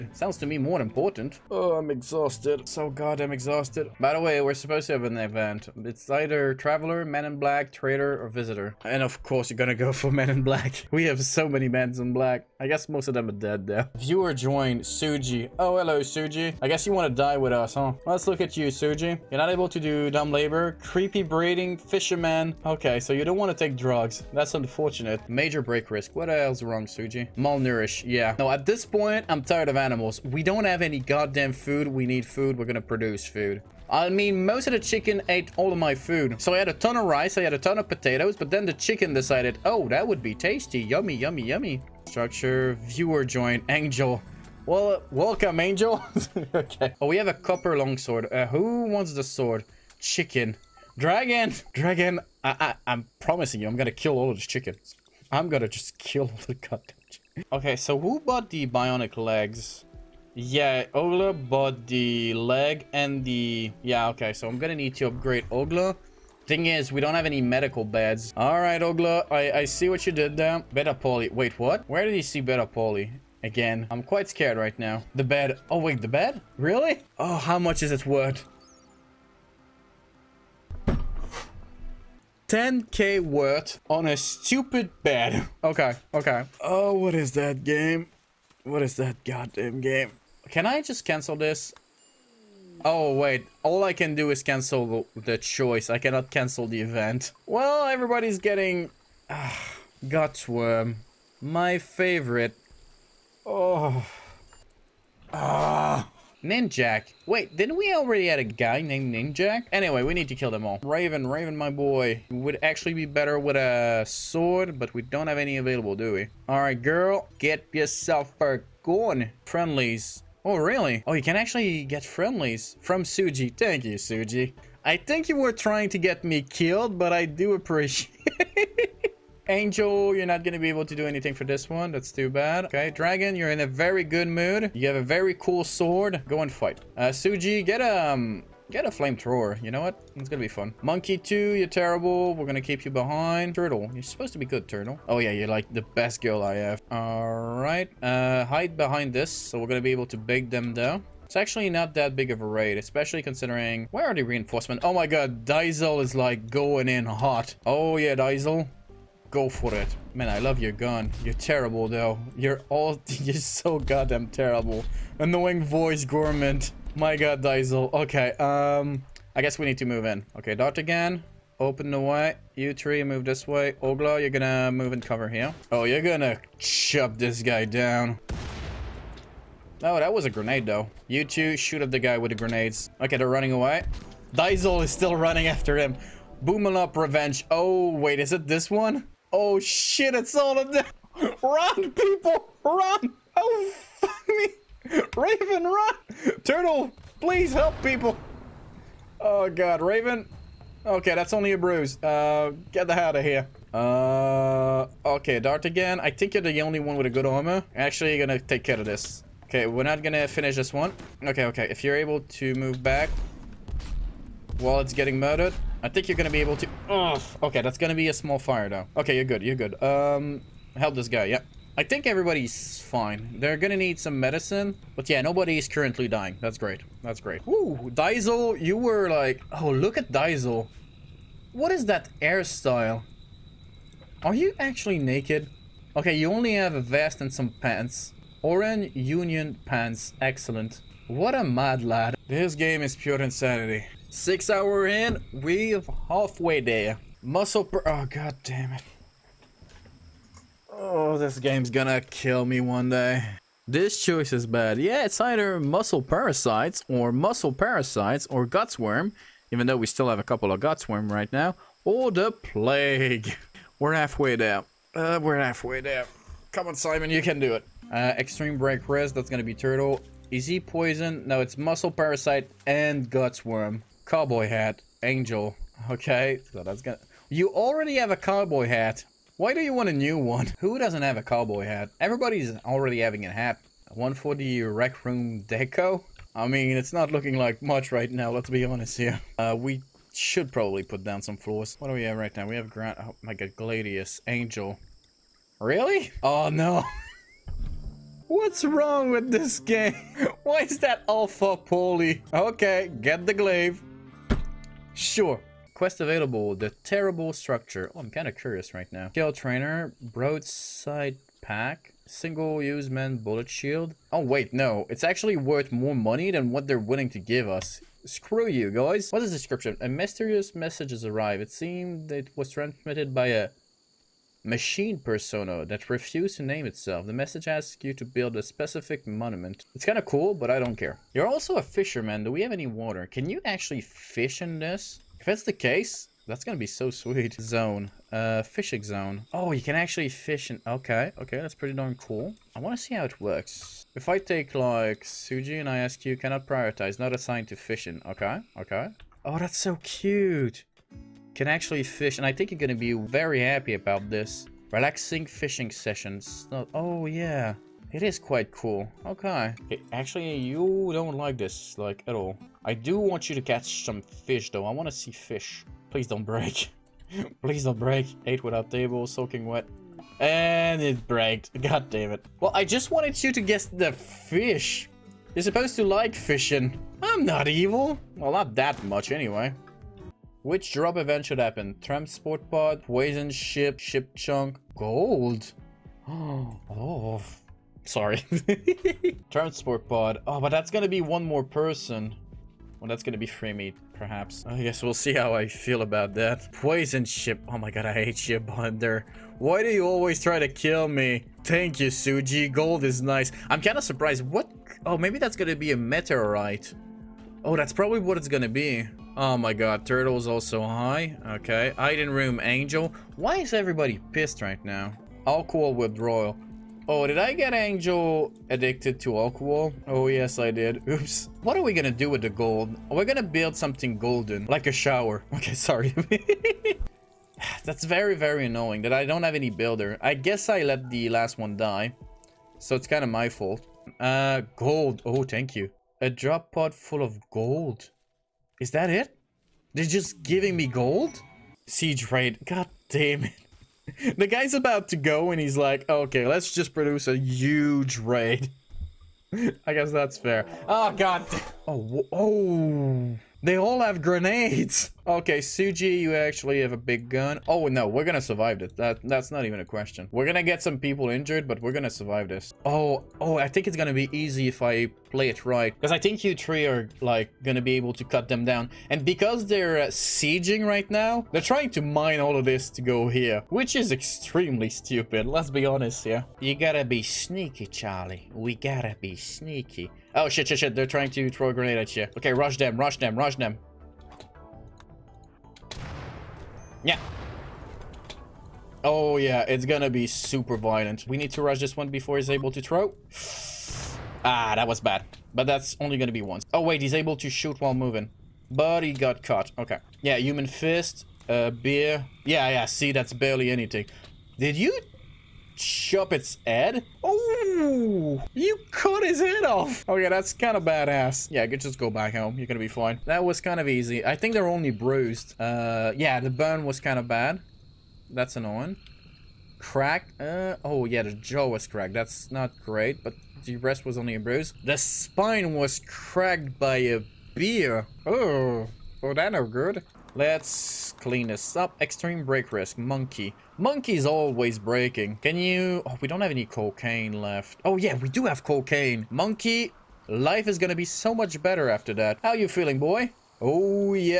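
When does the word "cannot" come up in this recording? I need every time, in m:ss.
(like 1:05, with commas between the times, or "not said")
1:35, 5:46.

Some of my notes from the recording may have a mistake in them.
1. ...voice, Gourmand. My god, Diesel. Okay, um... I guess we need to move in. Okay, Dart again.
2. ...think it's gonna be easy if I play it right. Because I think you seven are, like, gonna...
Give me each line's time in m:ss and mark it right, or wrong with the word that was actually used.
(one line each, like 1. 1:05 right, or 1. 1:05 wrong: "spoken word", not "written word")
1. 2:45 right
2. 7:43 wrong: "three", not "seven".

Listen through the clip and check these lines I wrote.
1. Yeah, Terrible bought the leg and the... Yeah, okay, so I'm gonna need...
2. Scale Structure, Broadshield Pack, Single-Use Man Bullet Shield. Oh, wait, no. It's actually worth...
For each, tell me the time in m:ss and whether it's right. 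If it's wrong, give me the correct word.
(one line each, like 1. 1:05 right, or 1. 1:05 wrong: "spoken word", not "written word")
1. 1:00 wrong: "Ogla", not "Terrible"
2. 5:09 wrong: "Trainer", not "Structure".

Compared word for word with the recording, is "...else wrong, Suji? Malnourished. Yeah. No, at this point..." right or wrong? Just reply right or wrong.
right.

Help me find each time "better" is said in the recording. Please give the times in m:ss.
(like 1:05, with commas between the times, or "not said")
1:53, 9:01.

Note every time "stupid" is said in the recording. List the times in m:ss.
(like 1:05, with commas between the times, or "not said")
1:24, 7:54.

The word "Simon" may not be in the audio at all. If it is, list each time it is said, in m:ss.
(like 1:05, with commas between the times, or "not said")
4:26.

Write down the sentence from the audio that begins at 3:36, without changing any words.
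Oh, okay, that's gonna be a small fire, though.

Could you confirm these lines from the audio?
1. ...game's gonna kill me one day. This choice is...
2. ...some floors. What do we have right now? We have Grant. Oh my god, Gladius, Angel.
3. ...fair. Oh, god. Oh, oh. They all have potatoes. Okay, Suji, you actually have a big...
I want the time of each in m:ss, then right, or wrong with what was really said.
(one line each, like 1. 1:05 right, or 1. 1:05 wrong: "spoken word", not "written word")
1. 4:11 right
2. 4:51 right
3. 7:30 wrong: "grenades", not "potatoes".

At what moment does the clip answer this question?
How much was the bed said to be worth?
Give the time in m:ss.
1:22.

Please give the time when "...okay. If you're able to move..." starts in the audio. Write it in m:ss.
3:31.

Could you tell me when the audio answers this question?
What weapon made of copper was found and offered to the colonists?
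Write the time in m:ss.
0:47.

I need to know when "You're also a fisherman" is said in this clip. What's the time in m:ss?
5:31.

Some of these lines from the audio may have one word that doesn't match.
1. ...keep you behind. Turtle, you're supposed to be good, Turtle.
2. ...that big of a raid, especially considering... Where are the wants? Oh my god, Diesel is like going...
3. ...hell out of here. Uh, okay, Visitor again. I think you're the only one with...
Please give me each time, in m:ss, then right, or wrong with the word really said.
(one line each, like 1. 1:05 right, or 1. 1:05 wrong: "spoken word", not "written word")
1. 2:22 right
2. 2:31 wrong: "reinforcements", not "wants"
3. 3:22 wrong: "Dart", not "Visitor".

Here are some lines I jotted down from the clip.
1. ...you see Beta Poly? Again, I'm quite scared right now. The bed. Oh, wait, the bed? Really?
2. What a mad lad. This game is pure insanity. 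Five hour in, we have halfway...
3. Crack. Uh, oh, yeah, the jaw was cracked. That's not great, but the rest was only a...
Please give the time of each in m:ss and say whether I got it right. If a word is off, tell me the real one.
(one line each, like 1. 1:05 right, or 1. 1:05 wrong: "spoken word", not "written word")
1. 1:12 right
2. 4:01 wrong: "Six", not "Five"
3. 8:39 right.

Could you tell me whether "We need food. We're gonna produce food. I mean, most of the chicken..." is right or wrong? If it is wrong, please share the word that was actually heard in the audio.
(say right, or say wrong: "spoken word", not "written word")
right.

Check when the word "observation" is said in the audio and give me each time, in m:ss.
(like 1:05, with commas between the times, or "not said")
not said.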